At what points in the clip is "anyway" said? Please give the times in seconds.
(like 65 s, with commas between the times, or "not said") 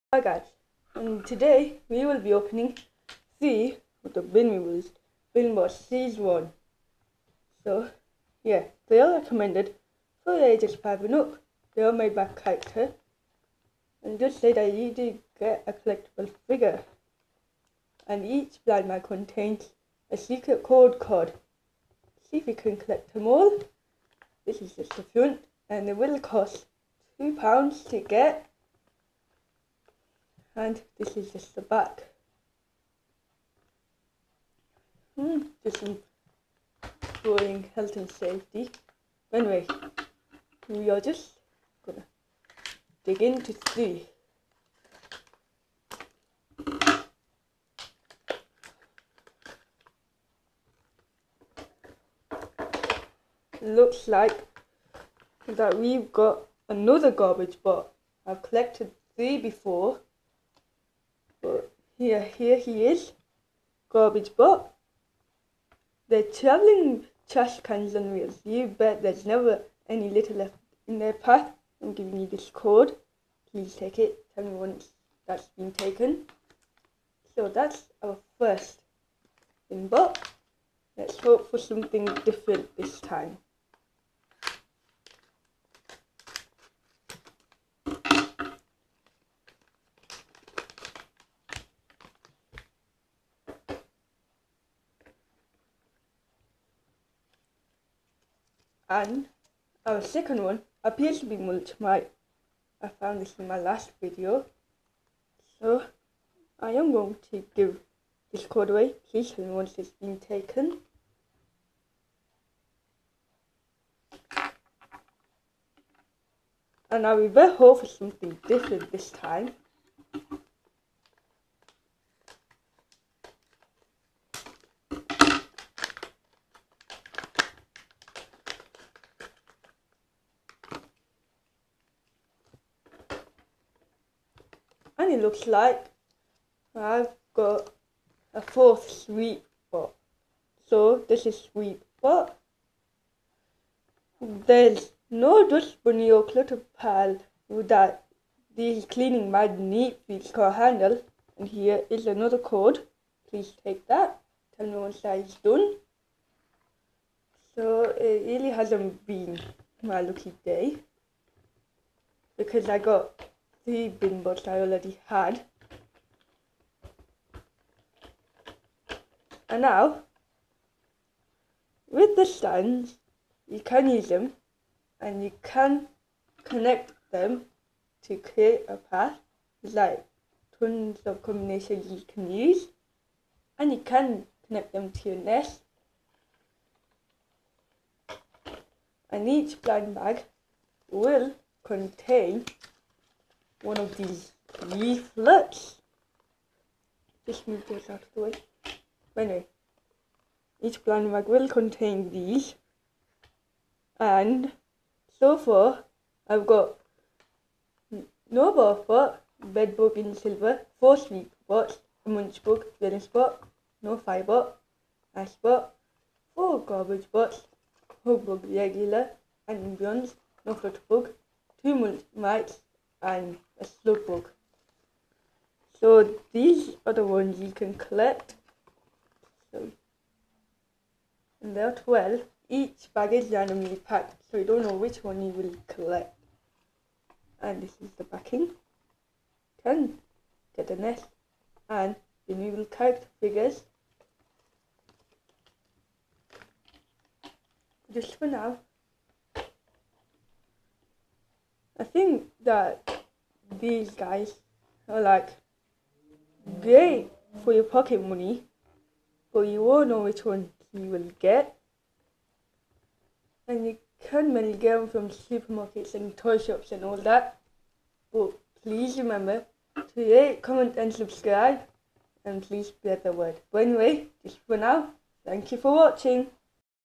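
39 s, 199 s, 273 s.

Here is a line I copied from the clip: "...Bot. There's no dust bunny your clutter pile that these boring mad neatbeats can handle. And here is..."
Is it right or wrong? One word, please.
wrong.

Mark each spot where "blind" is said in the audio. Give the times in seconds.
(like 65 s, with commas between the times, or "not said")
18 s, 189 s, 200 s.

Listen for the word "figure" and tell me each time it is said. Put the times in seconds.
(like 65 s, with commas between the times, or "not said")
16 s, 243 s.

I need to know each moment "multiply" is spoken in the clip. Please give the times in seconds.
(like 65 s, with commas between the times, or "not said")
101 s.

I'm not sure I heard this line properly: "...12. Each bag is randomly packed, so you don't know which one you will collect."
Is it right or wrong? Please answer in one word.
right.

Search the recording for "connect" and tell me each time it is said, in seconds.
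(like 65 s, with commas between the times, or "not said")
176 s, 184 s.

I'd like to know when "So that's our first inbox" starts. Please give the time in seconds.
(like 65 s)
77 s.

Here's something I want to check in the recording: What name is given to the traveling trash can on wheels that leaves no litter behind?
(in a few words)
Garbage Bot.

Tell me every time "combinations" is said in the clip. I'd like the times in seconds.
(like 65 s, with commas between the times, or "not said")
181 s.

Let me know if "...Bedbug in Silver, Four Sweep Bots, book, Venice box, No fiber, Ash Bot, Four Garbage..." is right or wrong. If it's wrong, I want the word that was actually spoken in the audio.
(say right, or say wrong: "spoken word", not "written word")
right.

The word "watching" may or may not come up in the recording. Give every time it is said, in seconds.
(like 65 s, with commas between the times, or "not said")
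275 s.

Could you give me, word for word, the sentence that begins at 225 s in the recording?
So these are the ones you can collect.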